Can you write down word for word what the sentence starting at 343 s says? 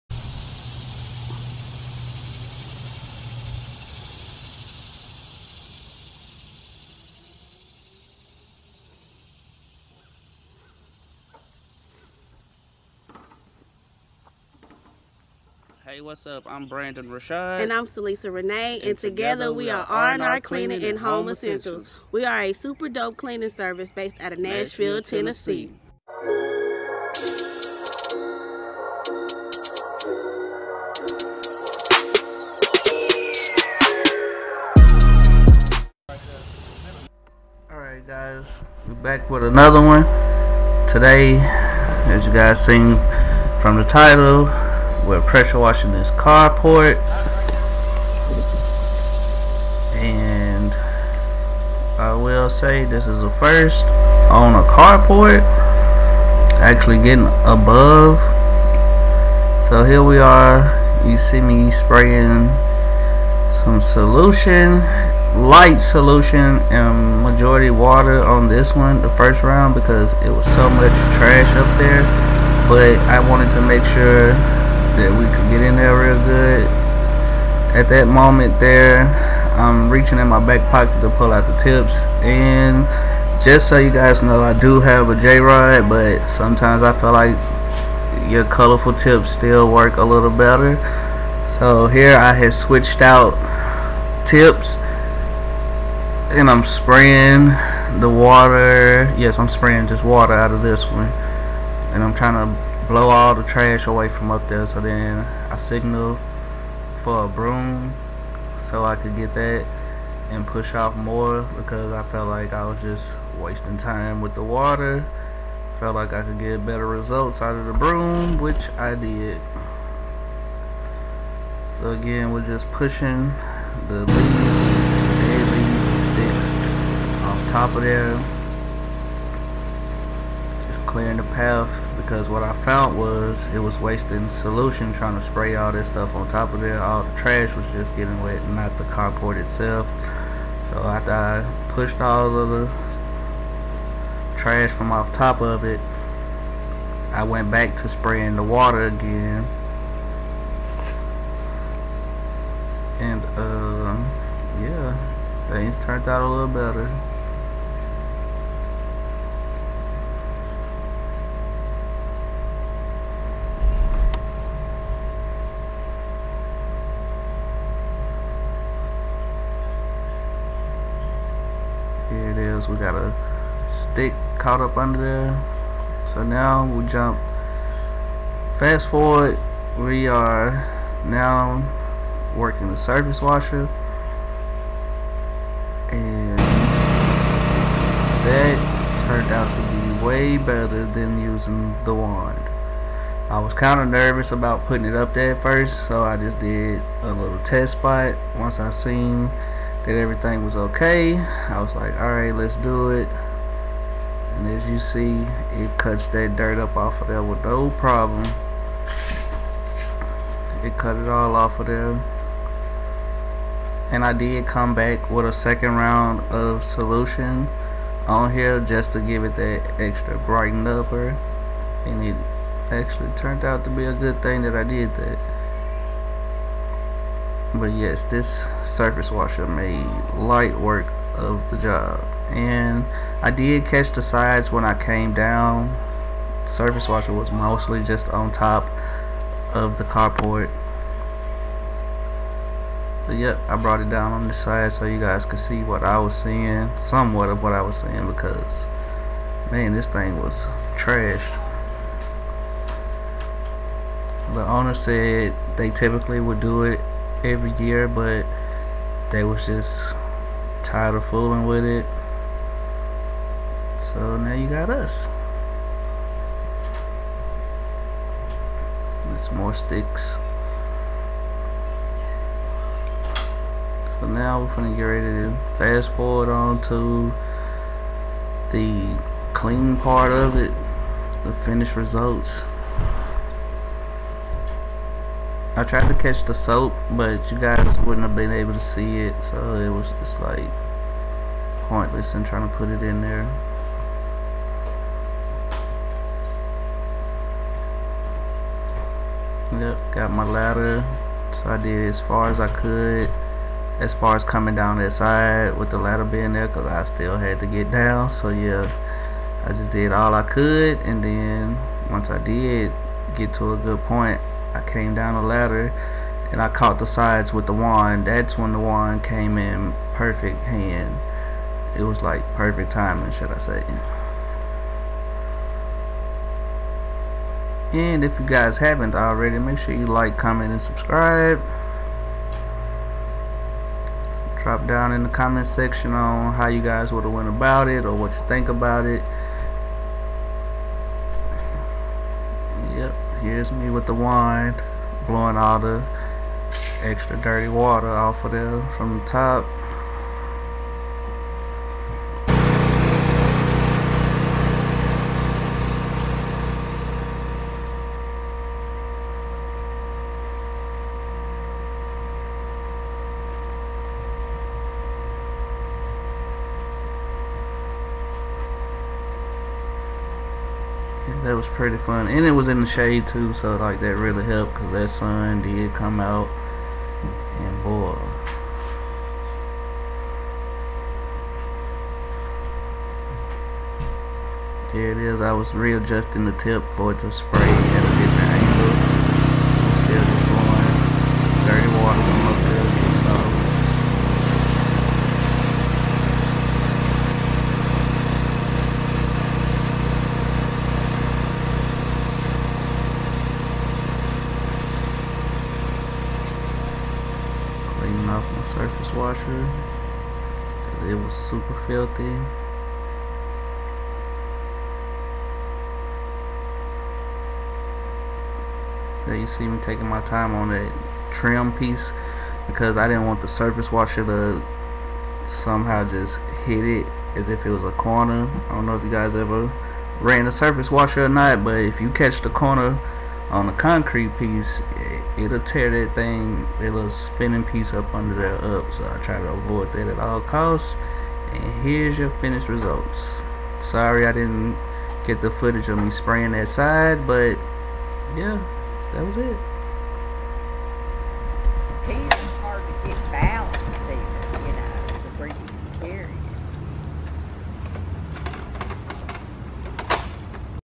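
Here's me with the wine blowing all the extra dirty water off of there from the top.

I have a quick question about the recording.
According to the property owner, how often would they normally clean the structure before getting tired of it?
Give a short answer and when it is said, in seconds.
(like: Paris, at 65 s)
Every year, at 257 s.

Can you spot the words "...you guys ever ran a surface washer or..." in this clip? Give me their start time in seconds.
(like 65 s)
428 s.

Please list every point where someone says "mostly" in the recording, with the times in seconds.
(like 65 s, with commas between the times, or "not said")
237 s.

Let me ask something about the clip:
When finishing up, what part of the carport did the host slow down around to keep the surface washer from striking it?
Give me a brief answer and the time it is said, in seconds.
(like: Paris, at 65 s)
Trim piece, at 421 s.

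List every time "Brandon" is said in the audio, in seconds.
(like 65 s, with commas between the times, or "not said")
16 s.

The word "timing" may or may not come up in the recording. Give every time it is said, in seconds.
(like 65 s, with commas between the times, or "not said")
322 s.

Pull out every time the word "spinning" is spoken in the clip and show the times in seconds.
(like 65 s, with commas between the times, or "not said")
436 s.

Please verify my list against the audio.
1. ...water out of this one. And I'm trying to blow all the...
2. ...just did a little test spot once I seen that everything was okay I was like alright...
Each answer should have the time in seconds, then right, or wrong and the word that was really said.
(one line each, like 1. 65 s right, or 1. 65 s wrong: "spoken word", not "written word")
1. 100 s right
2. 196 s right.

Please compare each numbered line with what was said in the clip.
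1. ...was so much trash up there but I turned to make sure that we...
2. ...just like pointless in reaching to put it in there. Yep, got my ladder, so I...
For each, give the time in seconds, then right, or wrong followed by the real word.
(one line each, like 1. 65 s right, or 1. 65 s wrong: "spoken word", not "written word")
1. 70 s wrong: "wanted", not "turned"
2. 289 s wrong: "trying", not "reaching".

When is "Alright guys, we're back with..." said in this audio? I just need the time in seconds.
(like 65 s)
37 s.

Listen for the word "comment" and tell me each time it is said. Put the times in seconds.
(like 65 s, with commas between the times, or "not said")
330 s, 335 s.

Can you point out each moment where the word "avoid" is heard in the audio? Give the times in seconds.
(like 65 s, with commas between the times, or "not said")
439 s.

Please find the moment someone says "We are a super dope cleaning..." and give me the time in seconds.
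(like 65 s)
22 s.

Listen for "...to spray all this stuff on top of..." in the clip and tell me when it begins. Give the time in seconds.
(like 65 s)
135 s.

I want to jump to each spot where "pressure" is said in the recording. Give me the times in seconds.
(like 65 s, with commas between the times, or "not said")
45 s.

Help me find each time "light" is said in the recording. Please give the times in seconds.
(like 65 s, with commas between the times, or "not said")
65 s, 230 s.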